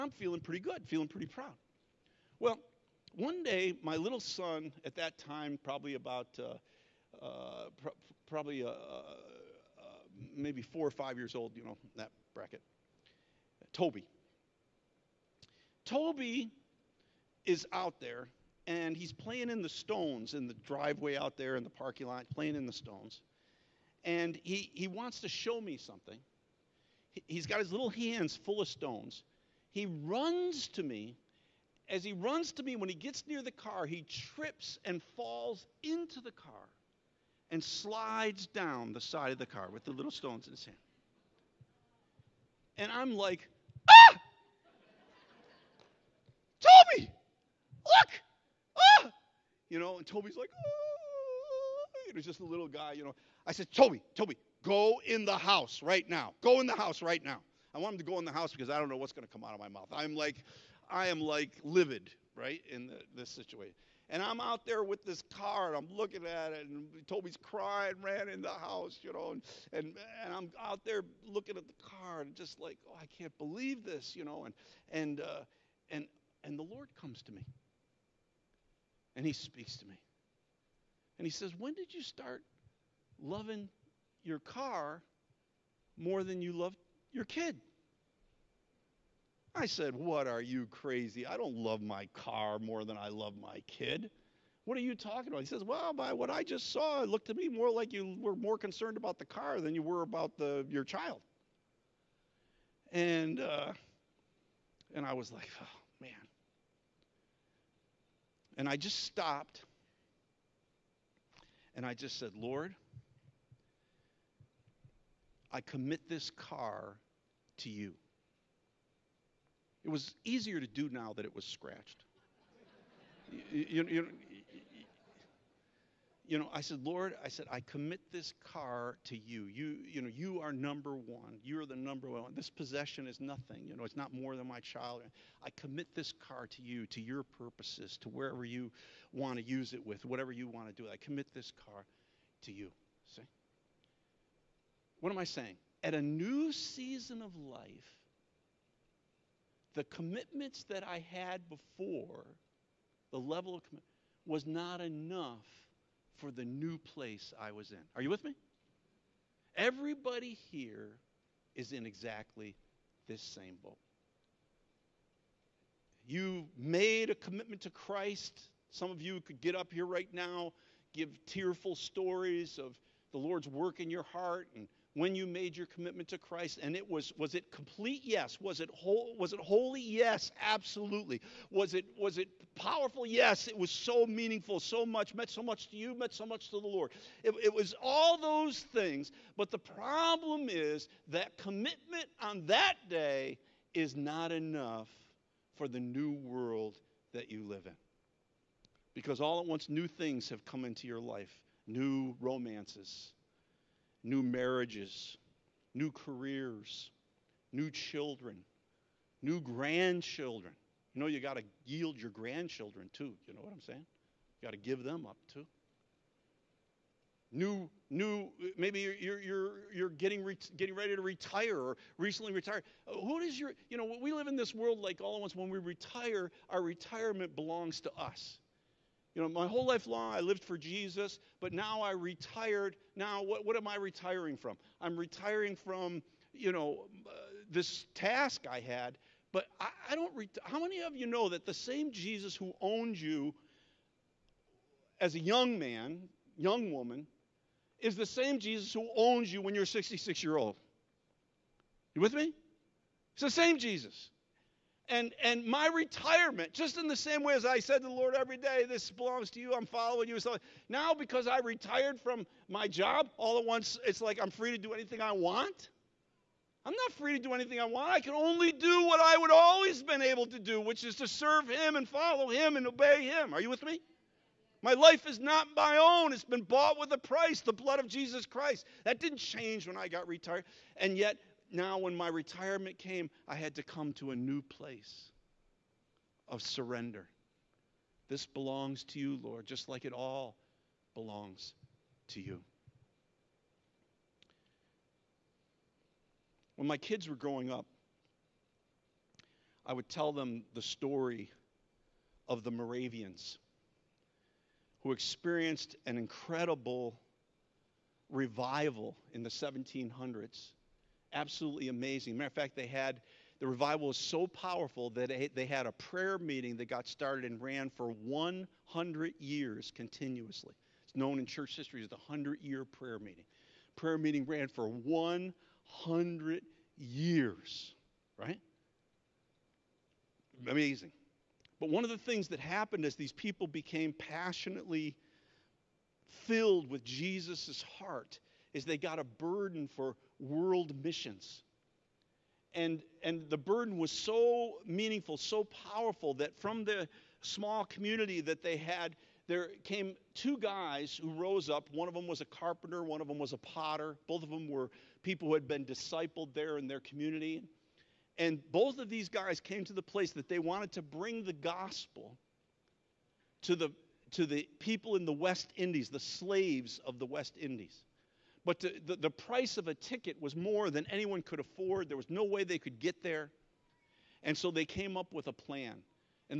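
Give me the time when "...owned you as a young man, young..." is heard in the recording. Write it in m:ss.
4:02.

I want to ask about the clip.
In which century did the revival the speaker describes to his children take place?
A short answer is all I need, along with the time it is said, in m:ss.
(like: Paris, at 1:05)
1700s, at 5:09.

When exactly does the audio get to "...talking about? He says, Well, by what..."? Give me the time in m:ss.
1:34.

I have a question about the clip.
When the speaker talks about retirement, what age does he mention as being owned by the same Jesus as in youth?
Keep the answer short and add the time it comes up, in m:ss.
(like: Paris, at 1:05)
66, at 4:09.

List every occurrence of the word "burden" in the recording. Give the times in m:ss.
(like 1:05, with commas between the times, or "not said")
5:39, 5:43.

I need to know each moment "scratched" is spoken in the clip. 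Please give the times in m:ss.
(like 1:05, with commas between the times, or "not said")
2:01.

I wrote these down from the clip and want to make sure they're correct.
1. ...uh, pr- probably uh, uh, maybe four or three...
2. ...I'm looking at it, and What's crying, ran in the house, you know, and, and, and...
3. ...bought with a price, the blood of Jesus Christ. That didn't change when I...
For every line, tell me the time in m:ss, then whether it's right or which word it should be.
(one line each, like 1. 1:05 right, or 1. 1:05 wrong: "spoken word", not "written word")
1. 0:07 wrong: "five", not "three"
2. 1:05 wrong: "Toby", not "What"
3. 4:36 right.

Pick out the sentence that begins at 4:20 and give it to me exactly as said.
So now, because I retired from my job, all at once, it's like I'm free to do anything I want.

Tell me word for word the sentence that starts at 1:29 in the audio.
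I said, What are you crazy?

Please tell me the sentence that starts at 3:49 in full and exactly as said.
You know, my whole life long I lived for Jesus, but now I retired.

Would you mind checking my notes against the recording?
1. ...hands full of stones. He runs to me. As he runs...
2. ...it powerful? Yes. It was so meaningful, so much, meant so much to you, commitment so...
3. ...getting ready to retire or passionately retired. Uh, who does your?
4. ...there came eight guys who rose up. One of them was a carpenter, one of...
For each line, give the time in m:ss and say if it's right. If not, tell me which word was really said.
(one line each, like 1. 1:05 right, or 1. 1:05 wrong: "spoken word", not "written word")
1. 0:27 right
2. 3:02 wrong: "meant", not "commitment"
3. 3:40 wrong: "recently", not "passionately"
4. 5:49 wrong: "two", not "eight".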